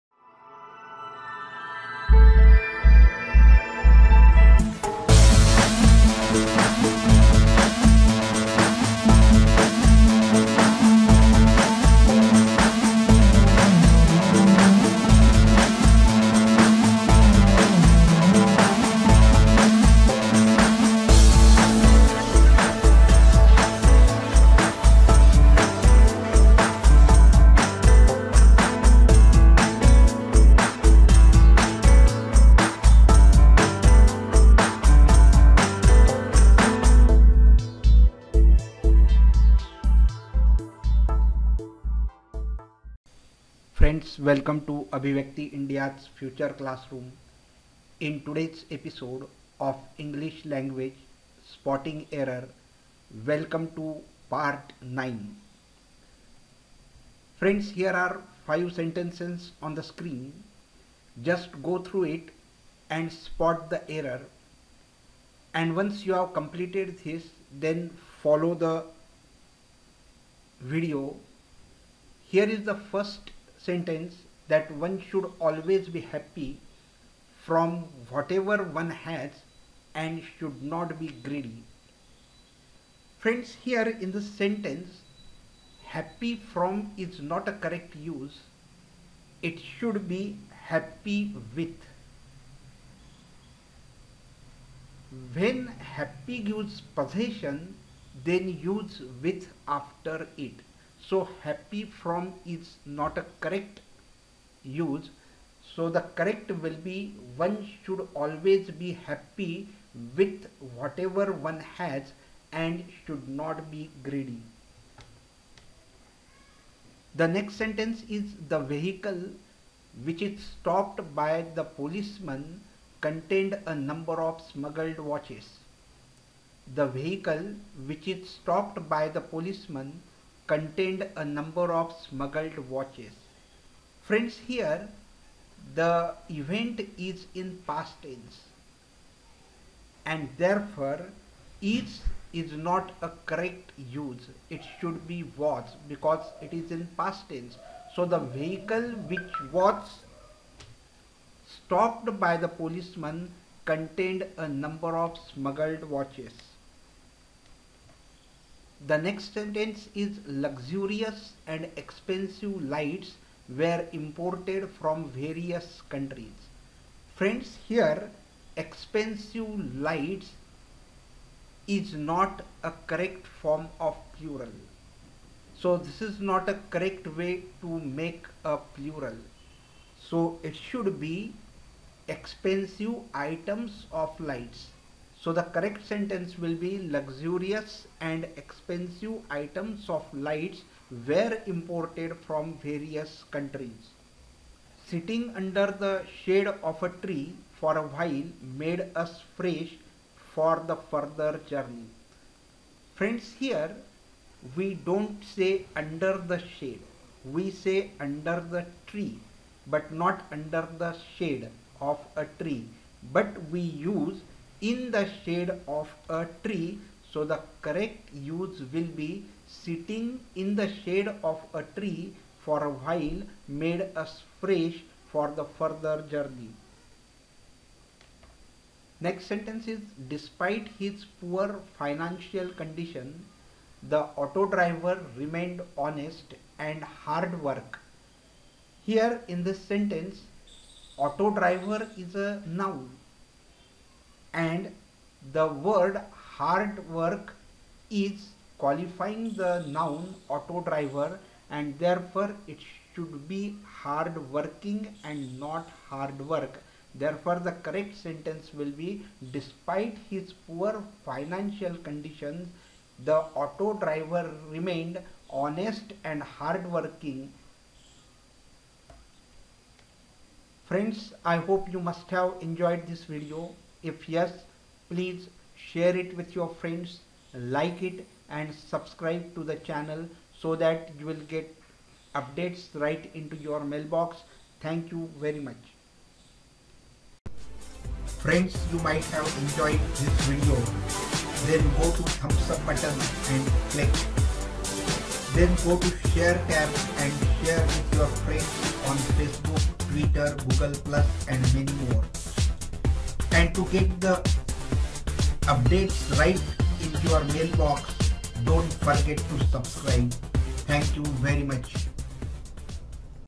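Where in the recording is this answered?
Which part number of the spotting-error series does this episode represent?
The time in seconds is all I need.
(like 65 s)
54 s.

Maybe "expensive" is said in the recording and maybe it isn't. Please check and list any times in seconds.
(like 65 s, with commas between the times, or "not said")
161 s, 168 s, 182 s, 188 s.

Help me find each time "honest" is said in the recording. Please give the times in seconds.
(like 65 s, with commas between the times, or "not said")
235 s, 265 s.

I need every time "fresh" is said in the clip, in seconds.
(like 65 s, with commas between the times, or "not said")
199 s, 224 s.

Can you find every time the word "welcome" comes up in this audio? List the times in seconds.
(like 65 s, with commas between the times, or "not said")
44 s, 53 s.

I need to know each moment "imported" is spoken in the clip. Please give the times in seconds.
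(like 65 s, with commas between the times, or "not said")
163 s, 191 s.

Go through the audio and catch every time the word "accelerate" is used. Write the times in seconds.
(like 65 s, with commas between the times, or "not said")
not said.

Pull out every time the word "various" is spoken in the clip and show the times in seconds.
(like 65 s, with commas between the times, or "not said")
165 s, 192 s.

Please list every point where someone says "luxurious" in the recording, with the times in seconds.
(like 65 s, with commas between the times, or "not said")
160 s, 186 s.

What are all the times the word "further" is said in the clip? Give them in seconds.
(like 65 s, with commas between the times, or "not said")
200 s, 225 s.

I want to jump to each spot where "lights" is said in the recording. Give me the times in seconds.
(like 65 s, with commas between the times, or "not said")
162 s, 169 s, 184 s, 190 s.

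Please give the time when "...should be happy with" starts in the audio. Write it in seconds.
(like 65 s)
89 s.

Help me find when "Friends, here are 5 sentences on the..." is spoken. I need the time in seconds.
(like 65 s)
57 s.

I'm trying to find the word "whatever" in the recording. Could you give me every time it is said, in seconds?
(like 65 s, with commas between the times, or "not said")
78 s, 110 s.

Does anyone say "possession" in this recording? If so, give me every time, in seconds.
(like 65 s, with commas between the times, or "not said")
96 s.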